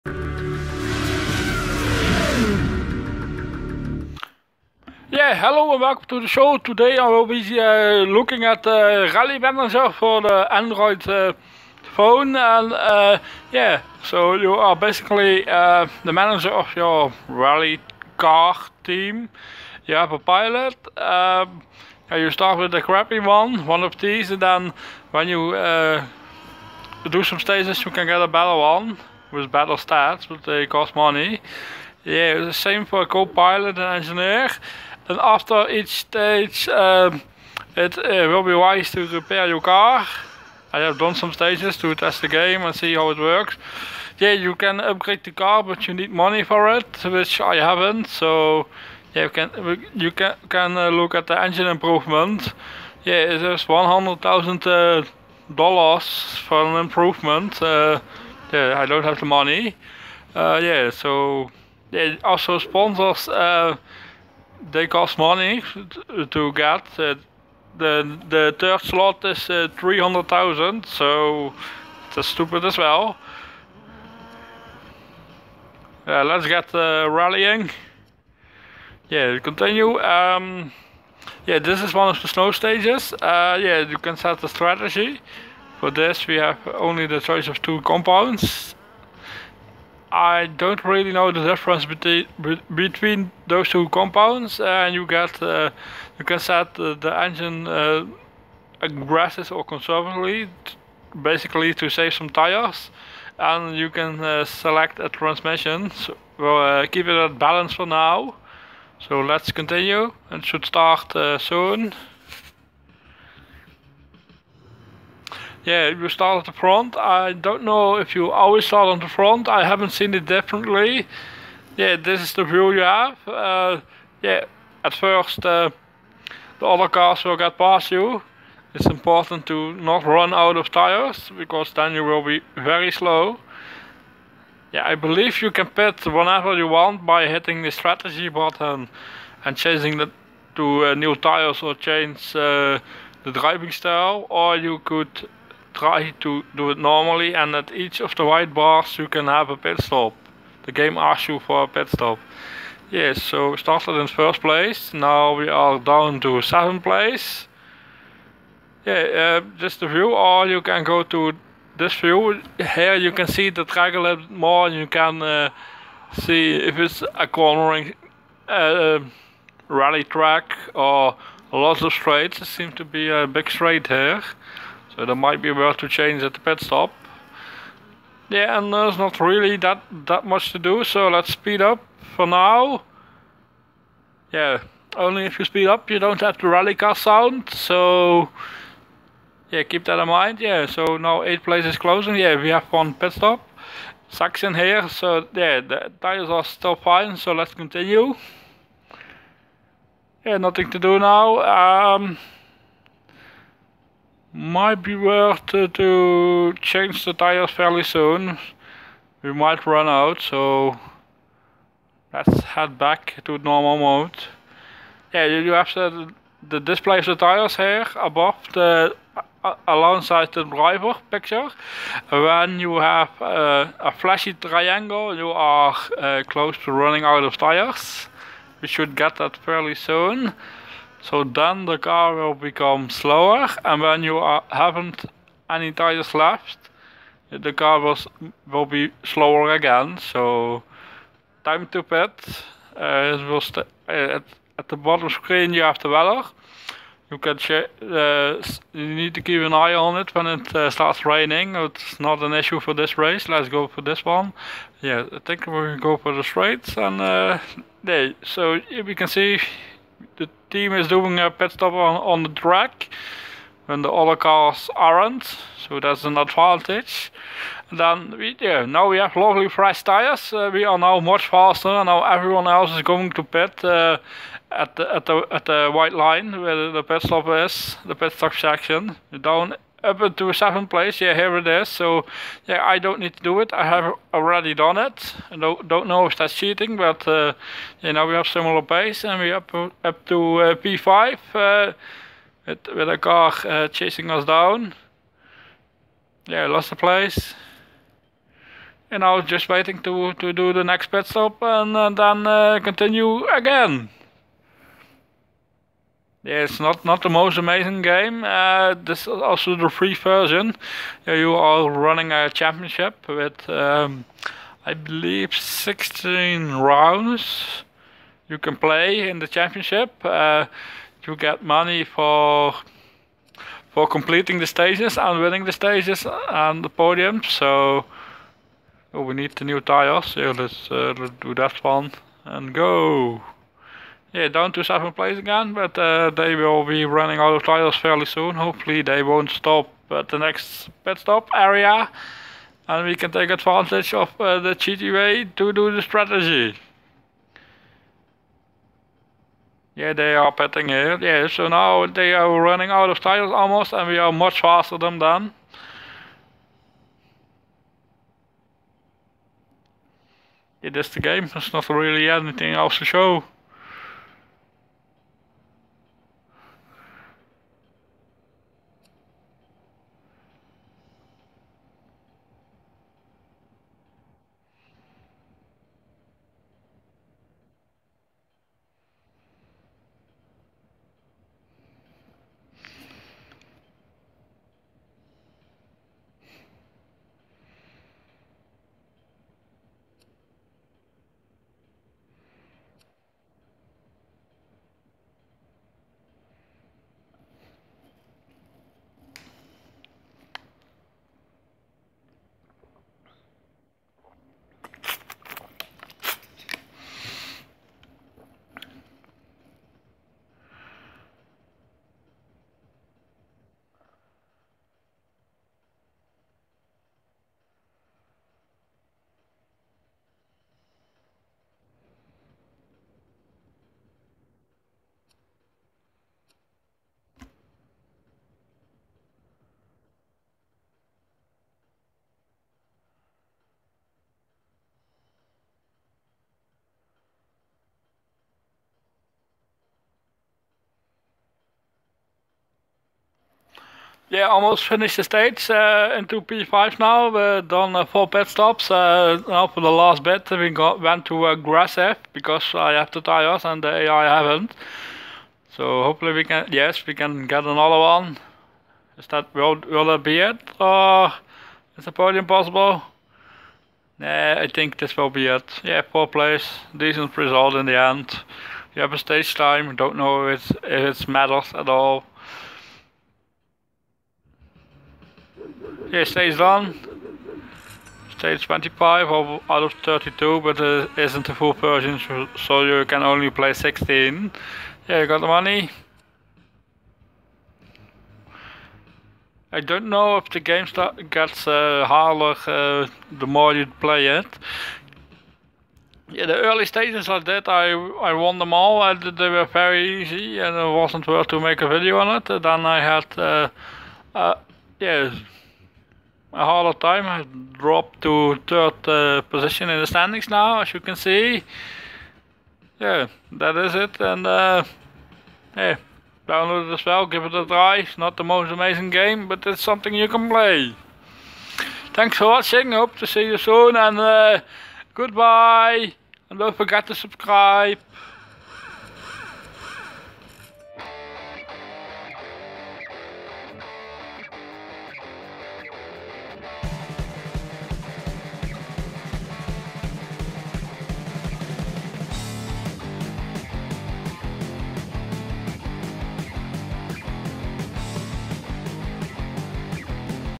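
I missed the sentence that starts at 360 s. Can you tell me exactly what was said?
It is the game, there's not really anything else to show.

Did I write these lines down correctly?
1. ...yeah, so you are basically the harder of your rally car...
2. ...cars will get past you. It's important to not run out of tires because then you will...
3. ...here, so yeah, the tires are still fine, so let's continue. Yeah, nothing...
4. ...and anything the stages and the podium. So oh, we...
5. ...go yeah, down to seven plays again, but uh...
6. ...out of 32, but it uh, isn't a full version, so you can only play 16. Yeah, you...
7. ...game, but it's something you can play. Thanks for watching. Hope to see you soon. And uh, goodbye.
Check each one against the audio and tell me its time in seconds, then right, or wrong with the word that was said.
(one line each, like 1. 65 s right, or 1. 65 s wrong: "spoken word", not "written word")
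1. 13 s wrong: "manager", not "harder"
2. 126 s right
3. 194 s right
4. 324 s wrong: "winning", not "anything"
5. 332 s right
6. 479 s right
7. 518 s right.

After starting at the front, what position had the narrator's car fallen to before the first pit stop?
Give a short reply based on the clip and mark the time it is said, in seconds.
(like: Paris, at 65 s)
7th, at 156 s.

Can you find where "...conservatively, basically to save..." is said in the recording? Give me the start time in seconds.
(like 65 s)
99 s.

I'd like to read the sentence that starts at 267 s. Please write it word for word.
And then we yeah, now we have lovely fresh tires.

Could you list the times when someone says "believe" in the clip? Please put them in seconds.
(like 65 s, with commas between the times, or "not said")
134 s, 314 s.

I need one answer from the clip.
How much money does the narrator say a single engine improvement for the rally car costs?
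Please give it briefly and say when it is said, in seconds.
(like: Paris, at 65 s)
$100,000, at 53 s.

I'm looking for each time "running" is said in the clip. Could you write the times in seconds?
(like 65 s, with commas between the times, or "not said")
226 s, 311 s, 336 s, 352 s.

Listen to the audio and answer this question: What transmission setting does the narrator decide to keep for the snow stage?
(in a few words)
Balance.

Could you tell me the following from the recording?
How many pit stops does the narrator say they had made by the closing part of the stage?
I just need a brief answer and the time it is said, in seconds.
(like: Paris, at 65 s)
4, at 447 s.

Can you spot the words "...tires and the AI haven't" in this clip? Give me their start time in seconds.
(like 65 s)
452 s.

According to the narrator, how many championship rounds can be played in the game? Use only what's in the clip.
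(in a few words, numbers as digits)
16.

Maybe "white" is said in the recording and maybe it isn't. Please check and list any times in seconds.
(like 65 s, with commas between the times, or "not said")
148 s, 275 s.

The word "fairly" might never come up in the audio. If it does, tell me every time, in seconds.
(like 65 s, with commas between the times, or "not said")
207 s, 229 s, 337 s.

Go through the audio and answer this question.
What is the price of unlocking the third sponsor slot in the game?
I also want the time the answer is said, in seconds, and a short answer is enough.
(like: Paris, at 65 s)
300,000, at 69 s.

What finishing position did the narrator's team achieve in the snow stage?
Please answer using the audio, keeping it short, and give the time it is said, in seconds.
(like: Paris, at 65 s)
Fourth, at 465 s.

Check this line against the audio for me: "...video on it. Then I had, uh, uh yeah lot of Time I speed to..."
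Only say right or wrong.
wrong.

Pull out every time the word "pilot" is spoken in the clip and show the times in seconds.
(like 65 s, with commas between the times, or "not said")
20 s, 33 s.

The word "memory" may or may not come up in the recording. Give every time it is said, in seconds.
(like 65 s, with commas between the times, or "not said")
not said.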